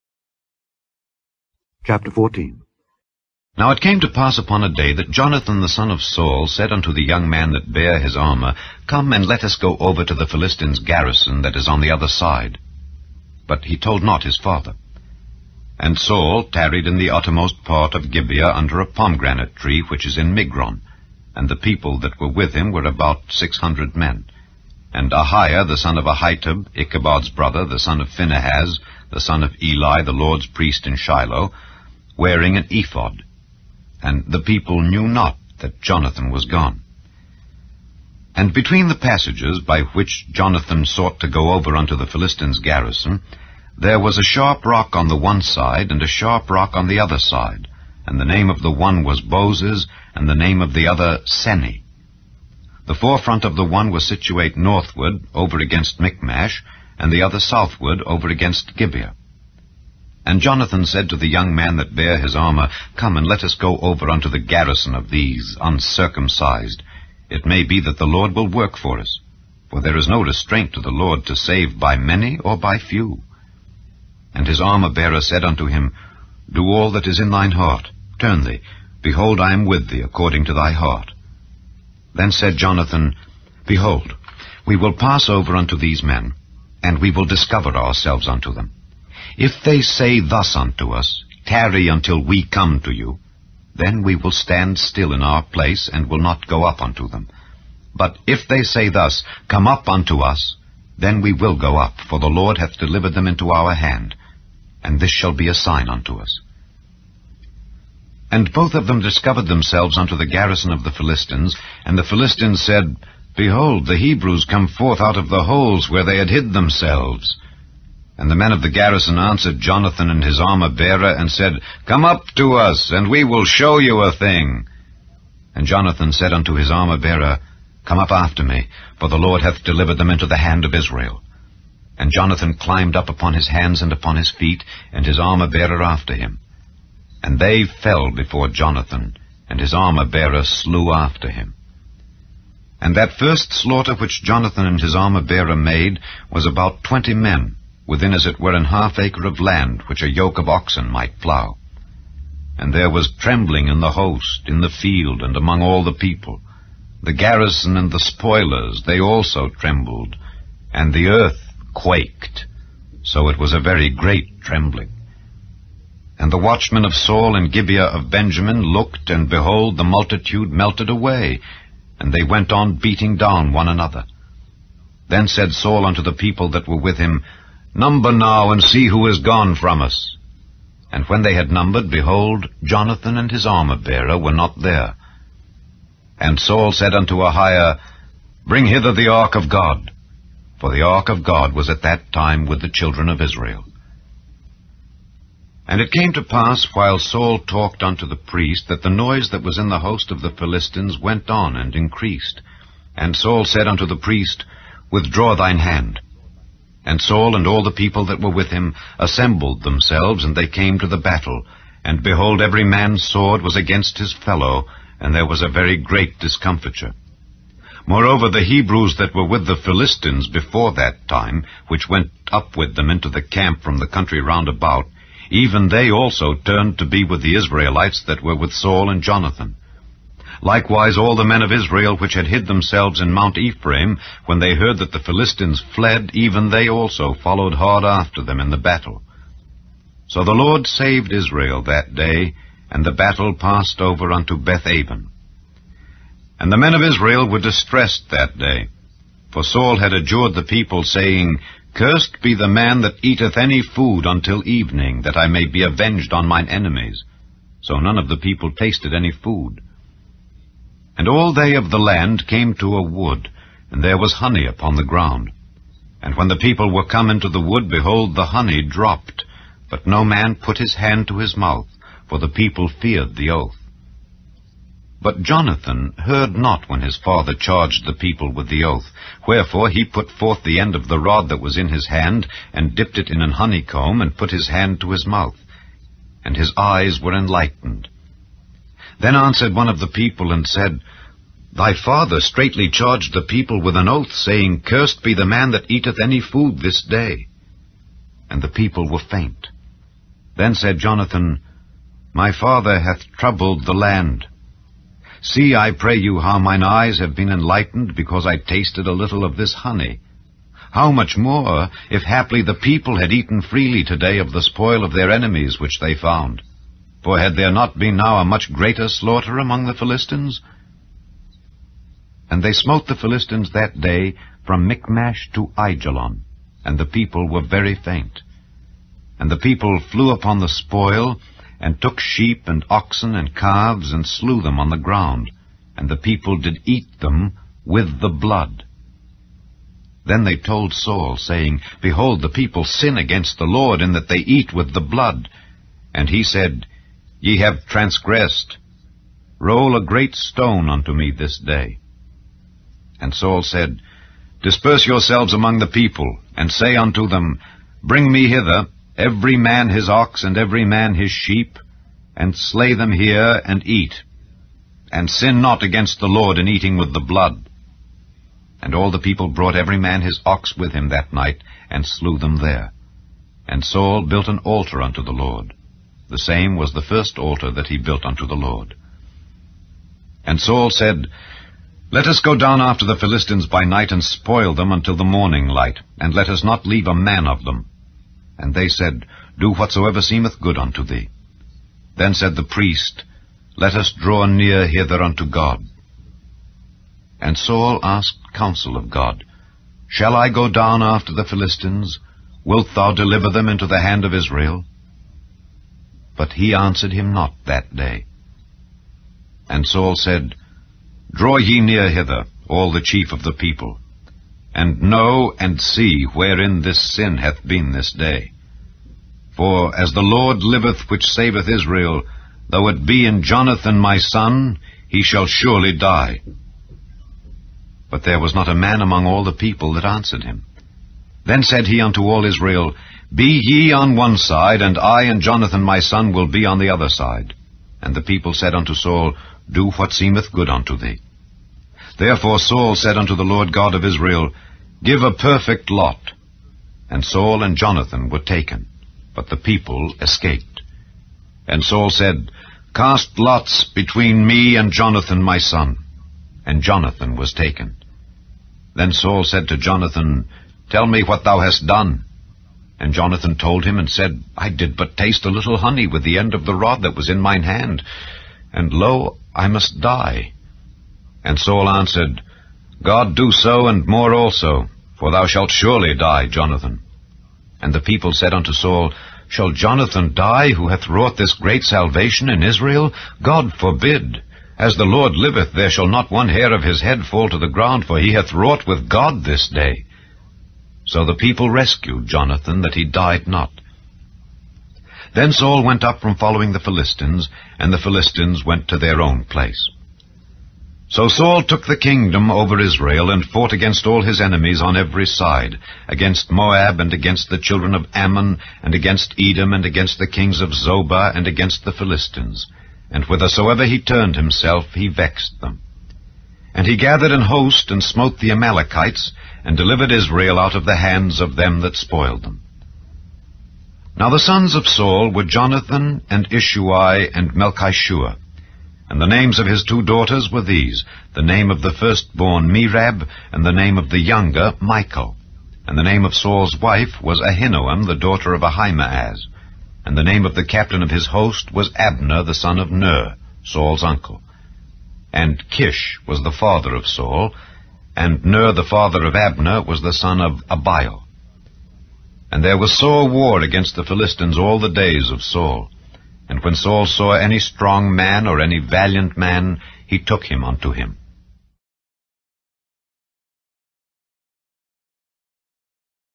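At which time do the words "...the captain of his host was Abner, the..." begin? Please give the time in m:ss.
9:00.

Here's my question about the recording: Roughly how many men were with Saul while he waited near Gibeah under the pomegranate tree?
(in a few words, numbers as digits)
600.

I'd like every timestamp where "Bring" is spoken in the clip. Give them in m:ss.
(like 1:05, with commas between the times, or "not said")
3:08, 5:57.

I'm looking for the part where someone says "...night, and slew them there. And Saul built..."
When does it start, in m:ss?
6:11.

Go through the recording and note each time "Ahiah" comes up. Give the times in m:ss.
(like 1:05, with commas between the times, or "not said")
0:25, 3:07.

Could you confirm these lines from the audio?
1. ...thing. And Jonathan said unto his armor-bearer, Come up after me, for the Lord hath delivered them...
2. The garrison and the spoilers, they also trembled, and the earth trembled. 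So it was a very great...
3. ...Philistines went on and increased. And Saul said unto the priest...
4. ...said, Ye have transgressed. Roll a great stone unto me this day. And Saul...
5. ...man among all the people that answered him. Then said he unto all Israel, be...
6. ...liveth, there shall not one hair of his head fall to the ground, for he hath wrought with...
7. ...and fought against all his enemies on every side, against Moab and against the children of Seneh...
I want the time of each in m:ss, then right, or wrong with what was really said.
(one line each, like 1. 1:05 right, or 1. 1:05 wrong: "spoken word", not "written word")
1. 2:04 right
2. 2:37 wrong: "quaked", not "trembled"
3. 3:20 right
4. 5:46 right
5. 7:08 right
6. 8:05 right
7. 8:23 wrong: "Ammon", not "Seneh".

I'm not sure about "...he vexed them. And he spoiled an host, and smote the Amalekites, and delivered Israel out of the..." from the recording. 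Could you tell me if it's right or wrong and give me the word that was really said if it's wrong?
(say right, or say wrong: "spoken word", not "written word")
wrong: "gathered", not "spoiled".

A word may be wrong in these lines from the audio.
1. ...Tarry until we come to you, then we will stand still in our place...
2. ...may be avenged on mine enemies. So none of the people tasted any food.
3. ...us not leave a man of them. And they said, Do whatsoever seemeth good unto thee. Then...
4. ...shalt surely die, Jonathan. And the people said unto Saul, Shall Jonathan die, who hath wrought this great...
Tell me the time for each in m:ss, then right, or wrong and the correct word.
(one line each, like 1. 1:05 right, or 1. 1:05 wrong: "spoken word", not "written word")
1. 1:31 right
2. 4:15 right
3. 6:26 right
4. 7:55 right.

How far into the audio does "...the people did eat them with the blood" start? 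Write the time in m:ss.
5:35.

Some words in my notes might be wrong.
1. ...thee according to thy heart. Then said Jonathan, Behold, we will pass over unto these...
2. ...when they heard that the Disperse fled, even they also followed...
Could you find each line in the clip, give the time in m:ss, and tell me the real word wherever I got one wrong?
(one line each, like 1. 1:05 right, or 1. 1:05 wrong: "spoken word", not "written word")
1. 1:19 right
2. 3:54 wrong: "Philistines", not "Disperse".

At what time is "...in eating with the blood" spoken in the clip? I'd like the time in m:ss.
6:06.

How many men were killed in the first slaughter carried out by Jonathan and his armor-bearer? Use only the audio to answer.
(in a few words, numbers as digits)
20.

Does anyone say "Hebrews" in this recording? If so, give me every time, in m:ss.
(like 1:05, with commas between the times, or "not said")
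1:53, 3:38.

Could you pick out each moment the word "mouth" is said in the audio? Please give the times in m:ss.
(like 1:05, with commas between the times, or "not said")
4:31, 4:45.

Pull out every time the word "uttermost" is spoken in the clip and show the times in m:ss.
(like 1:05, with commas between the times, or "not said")
0:17.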